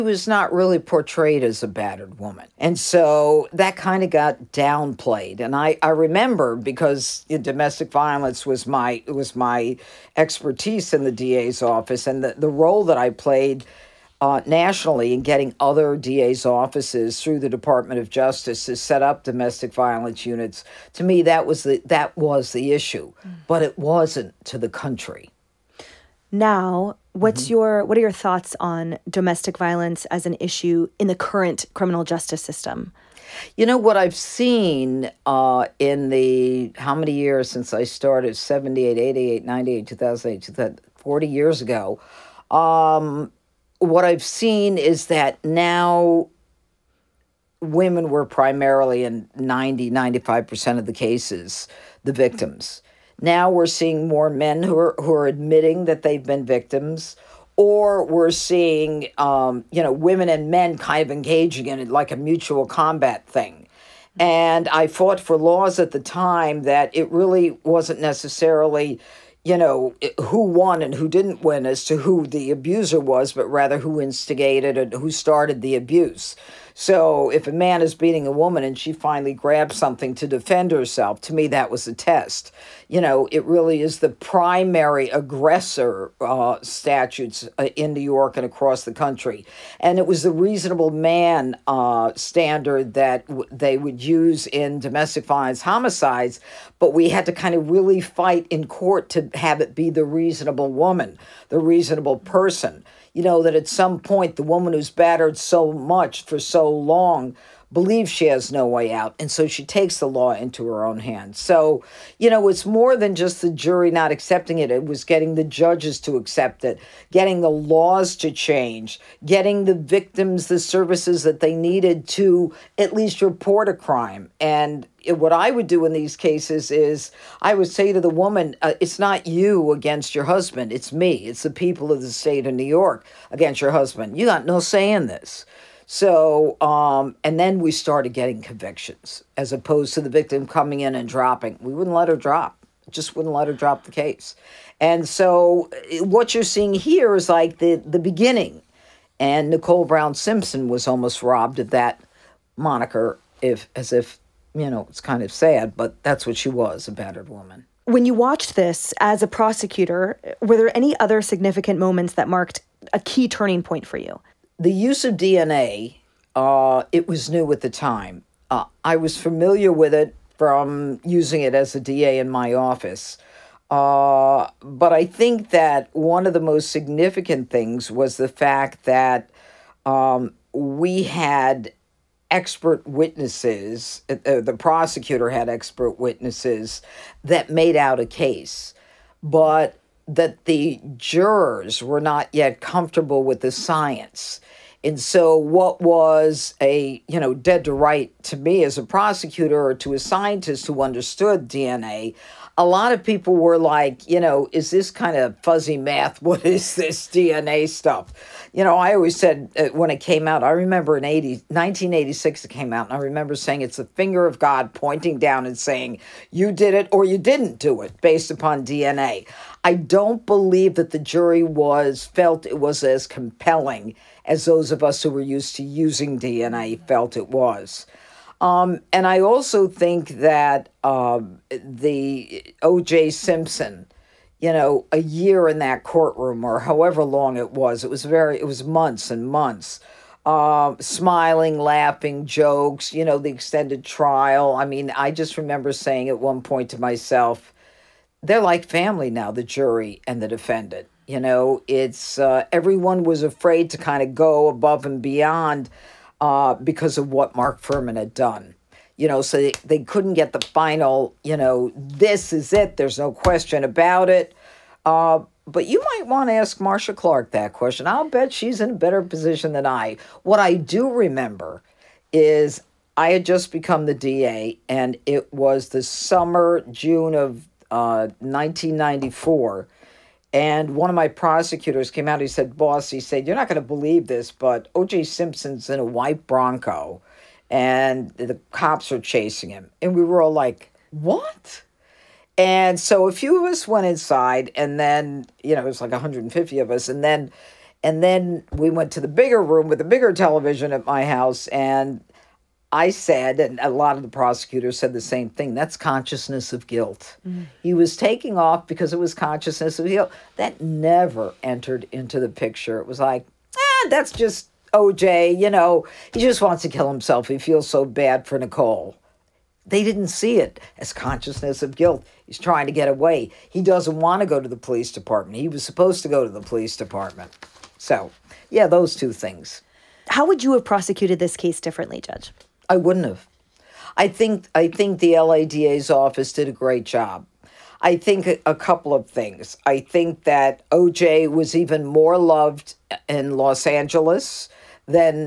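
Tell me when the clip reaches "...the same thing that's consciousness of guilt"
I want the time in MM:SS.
05:04.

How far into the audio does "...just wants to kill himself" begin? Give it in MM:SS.
05:16.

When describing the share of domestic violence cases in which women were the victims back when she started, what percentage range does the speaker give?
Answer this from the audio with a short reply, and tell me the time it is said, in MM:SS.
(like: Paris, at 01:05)
90, 95%, at 00:49.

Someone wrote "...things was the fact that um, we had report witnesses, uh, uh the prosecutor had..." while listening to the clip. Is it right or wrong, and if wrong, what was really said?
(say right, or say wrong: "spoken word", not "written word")
wrong: "expert", not "report".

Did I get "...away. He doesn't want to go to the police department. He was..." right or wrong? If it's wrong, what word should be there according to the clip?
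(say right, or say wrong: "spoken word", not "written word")
right.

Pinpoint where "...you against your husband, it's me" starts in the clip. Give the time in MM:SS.
02:09.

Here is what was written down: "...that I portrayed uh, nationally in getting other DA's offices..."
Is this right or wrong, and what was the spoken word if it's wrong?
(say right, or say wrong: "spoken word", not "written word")
wrong: "played", not "portrayed".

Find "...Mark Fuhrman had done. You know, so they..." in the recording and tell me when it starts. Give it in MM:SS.
04:17.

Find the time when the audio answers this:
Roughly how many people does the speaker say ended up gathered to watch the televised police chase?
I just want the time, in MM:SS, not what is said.
04:55.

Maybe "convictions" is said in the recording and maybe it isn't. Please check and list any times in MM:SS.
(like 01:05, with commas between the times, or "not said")
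02:18.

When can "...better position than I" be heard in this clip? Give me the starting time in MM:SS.
04:28.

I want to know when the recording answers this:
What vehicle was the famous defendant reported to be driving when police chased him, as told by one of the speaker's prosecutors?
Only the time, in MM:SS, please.
04:45.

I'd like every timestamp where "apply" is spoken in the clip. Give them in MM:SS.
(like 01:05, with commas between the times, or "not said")
not said.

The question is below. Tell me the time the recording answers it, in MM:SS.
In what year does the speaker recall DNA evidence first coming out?
03:31.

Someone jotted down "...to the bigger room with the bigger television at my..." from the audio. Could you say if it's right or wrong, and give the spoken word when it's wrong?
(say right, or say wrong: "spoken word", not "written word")
right.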